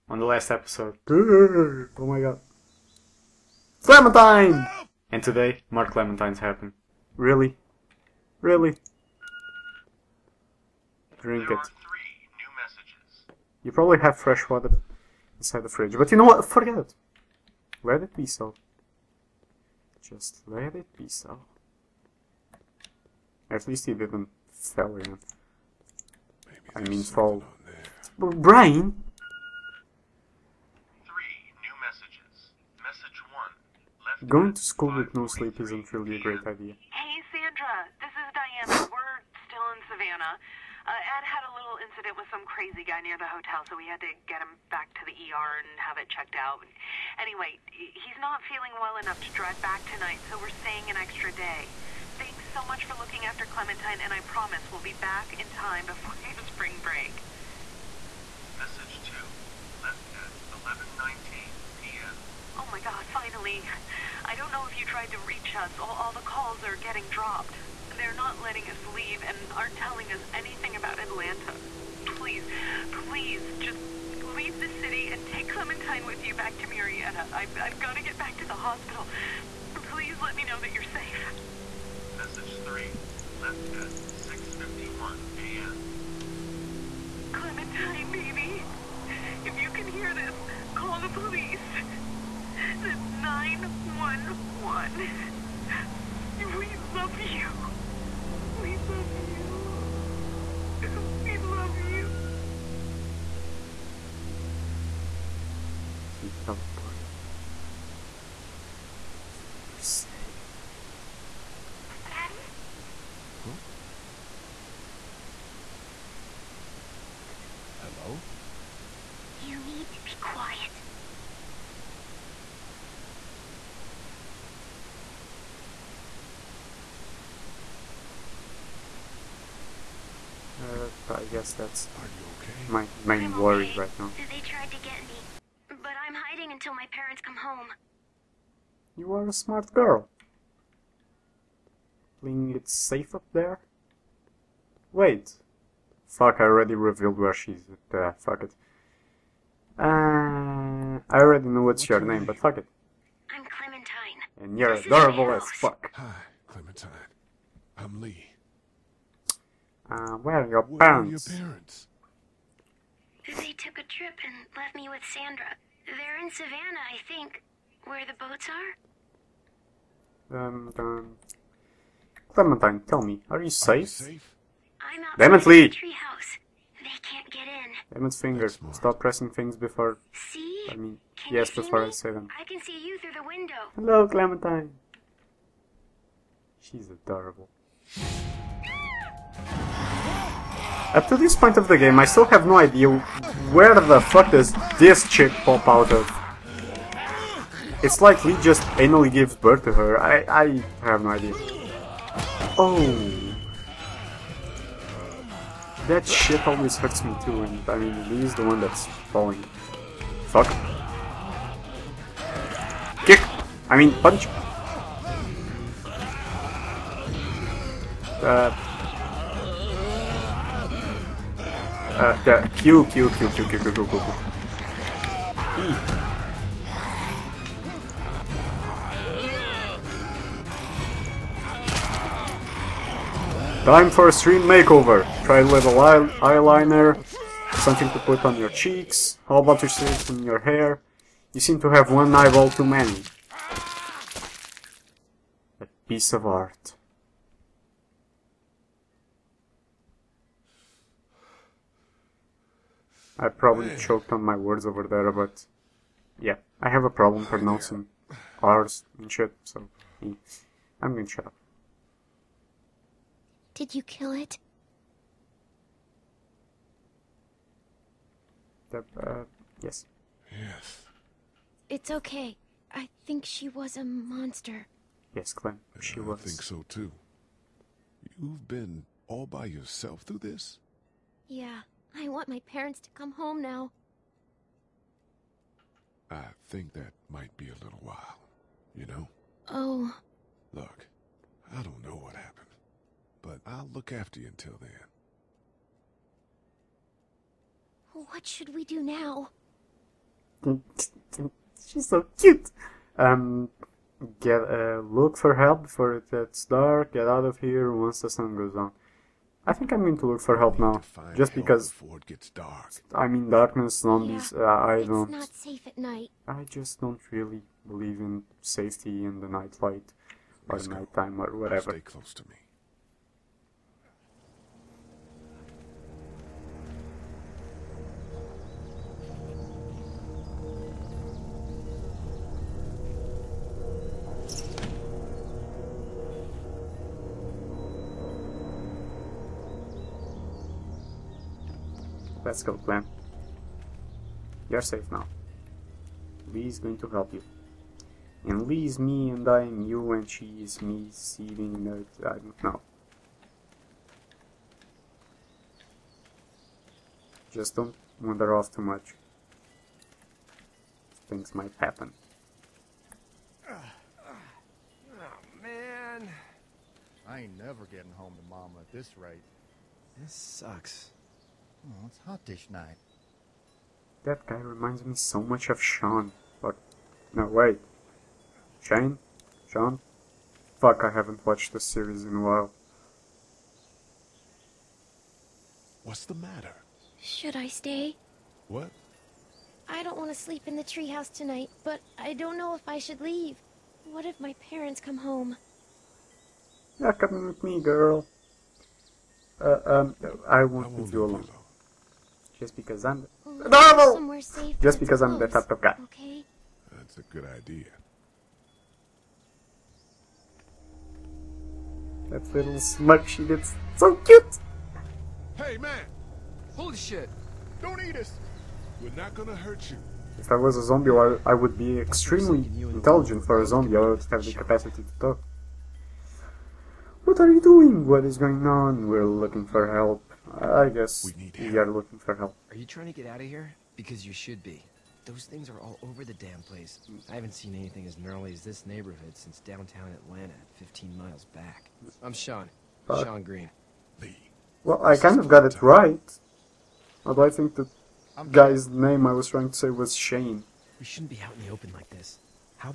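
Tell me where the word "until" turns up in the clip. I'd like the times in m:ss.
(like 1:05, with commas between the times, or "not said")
2:16, 4:54.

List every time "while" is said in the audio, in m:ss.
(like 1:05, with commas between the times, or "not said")
4:47, 6:22.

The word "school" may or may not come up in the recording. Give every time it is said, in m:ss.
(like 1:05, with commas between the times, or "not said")
0:34.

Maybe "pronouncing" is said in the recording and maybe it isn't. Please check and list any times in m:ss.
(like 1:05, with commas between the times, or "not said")
4:17.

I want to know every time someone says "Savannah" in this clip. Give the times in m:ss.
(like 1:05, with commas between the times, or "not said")
0:39, 2:46.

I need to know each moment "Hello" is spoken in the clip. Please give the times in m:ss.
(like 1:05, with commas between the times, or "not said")
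1:57, 3:03.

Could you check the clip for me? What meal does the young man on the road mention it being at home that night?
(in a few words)
Hot dish.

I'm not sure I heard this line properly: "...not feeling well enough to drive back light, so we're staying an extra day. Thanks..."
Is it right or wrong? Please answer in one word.
wrong.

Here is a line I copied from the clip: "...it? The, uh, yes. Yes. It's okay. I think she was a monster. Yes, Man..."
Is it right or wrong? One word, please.
wrong.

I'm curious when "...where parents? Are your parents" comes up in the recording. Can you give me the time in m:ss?
2:40.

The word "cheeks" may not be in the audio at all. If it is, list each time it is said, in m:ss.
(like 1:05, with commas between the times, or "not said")
3:58.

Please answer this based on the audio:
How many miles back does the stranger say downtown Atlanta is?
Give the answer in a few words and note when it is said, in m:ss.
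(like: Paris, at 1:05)
15, at 7:20.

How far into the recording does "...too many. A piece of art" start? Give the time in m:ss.
4:02.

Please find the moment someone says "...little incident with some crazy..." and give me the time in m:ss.
0:41.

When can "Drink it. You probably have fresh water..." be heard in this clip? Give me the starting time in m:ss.
0:11.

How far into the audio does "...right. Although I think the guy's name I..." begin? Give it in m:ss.
7:25.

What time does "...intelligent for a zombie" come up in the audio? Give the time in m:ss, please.
7:02.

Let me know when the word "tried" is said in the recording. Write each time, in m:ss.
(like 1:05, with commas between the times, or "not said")
1:04, 2:14.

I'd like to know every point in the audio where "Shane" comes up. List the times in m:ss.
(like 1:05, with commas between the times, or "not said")
6:18, 7:29.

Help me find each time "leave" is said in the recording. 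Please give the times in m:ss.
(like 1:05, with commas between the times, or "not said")
1:08, 1:14, 6:33, 6:40.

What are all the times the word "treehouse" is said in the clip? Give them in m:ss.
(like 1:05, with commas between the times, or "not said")
2:55, 6:30.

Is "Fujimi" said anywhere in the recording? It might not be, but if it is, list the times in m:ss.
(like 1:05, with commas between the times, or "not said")
not said.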